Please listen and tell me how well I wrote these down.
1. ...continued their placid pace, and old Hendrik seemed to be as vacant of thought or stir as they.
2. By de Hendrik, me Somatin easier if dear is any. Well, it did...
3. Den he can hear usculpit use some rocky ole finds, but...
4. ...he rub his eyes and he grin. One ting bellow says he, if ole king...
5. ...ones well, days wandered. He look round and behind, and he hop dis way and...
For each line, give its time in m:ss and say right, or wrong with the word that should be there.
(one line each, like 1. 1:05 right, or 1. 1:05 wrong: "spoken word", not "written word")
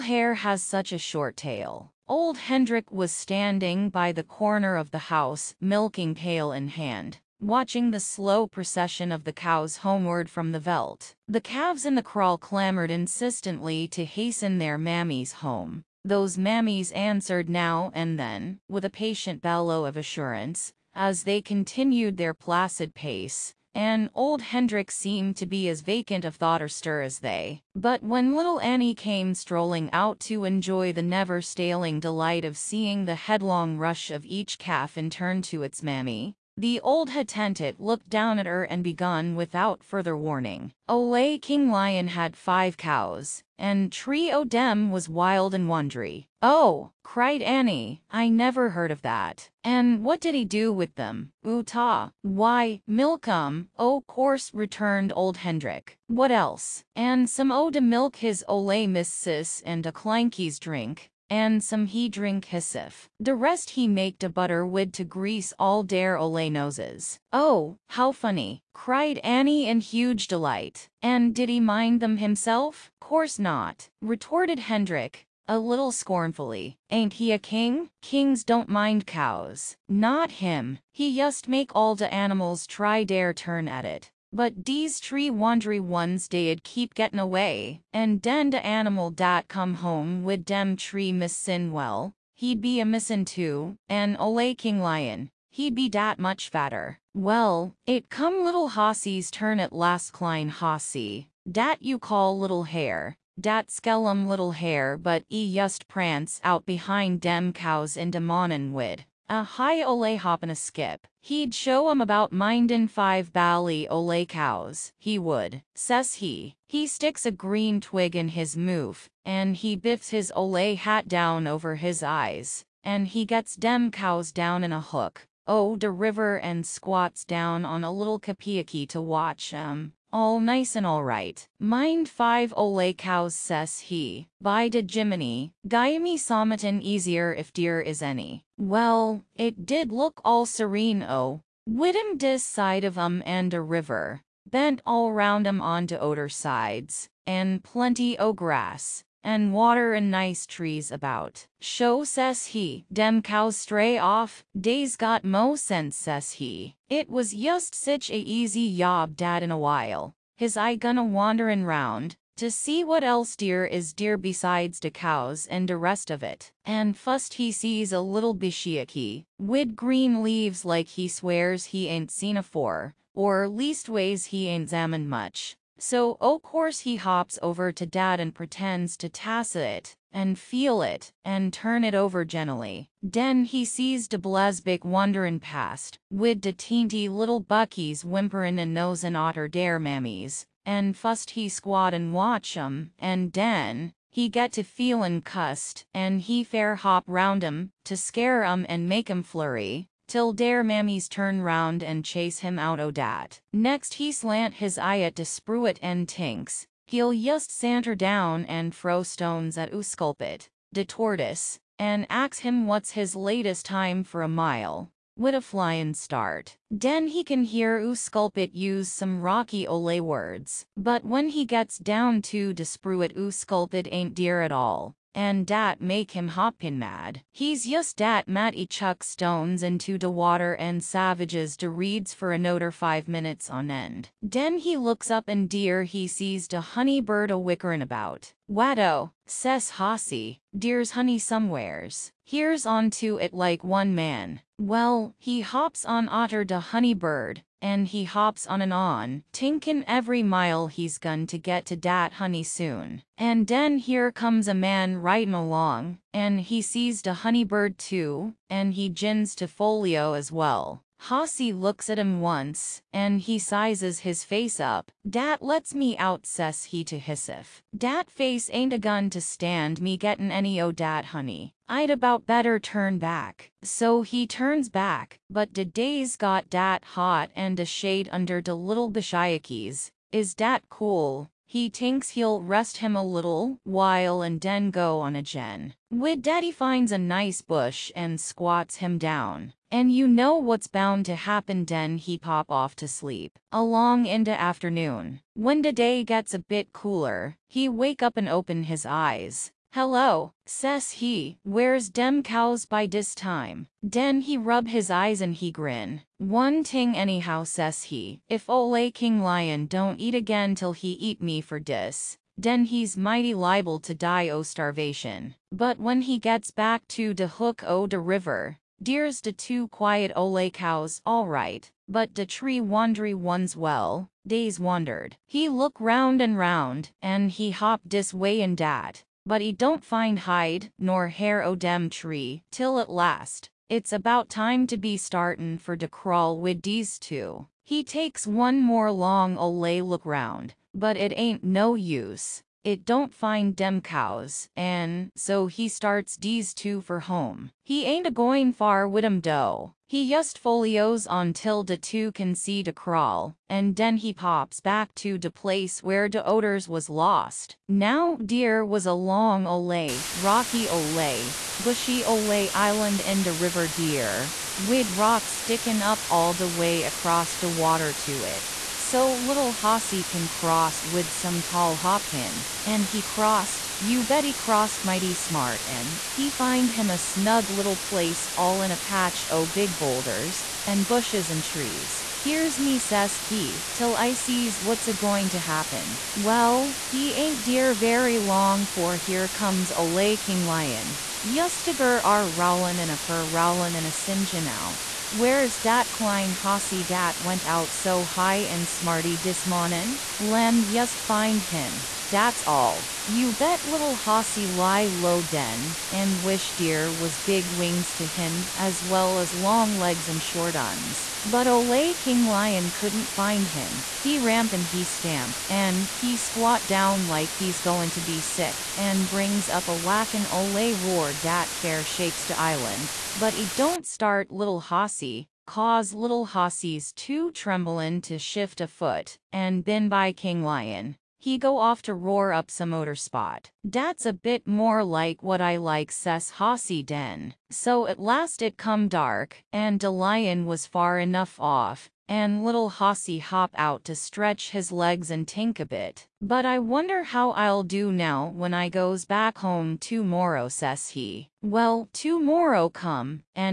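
1. 0:21 right
2. 2:14 wrong: "Jiminy", not "Hendrik"
3. 3:36 wrong: "words", not "finds"
4. 5:04 wrong: "anyhow", not "bellow"
5. 5:23 wrong: "round", not "behind".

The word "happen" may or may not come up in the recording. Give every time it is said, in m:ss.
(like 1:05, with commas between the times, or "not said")
4:51, 6:25.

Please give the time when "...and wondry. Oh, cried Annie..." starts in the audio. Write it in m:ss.
0:45.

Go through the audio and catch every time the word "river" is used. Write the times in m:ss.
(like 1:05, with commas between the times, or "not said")
2:05, 2:23, 5:17, 6:03.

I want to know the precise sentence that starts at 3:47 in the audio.
He's just dat Matty chuck stones into de water and savages de reeds for another five minutes on end.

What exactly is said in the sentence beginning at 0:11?
The calves in the kraal clamored insistently to hasten their mammies home.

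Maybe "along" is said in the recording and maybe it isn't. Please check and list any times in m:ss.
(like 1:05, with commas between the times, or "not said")
4:15, 4:53.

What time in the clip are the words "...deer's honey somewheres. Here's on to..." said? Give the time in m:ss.
4:00.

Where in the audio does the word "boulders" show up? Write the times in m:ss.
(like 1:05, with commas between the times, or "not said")
6:19.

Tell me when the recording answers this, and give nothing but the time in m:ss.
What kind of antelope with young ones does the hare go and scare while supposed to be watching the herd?
3:04.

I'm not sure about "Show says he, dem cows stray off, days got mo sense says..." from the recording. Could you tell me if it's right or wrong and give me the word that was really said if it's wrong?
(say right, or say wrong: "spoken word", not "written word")
right.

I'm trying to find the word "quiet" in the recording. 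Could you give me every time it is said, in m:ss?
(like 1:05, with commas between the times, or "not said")
5:19.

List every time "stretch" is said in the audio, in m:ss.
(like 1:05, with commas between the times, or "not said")
7:23.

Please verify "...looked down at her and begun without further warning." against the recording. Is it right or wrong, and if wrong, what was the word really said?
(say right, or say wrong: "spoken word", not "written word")
right.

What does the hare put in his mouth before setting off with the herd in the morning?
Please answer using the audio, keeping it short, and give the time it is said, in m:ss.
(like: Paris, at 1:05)
A green twig, at 1:57.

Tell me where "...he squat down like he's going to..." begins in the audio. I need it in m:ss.
6:55.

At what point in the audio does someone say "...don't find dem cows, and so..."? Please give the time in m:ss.
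5:42.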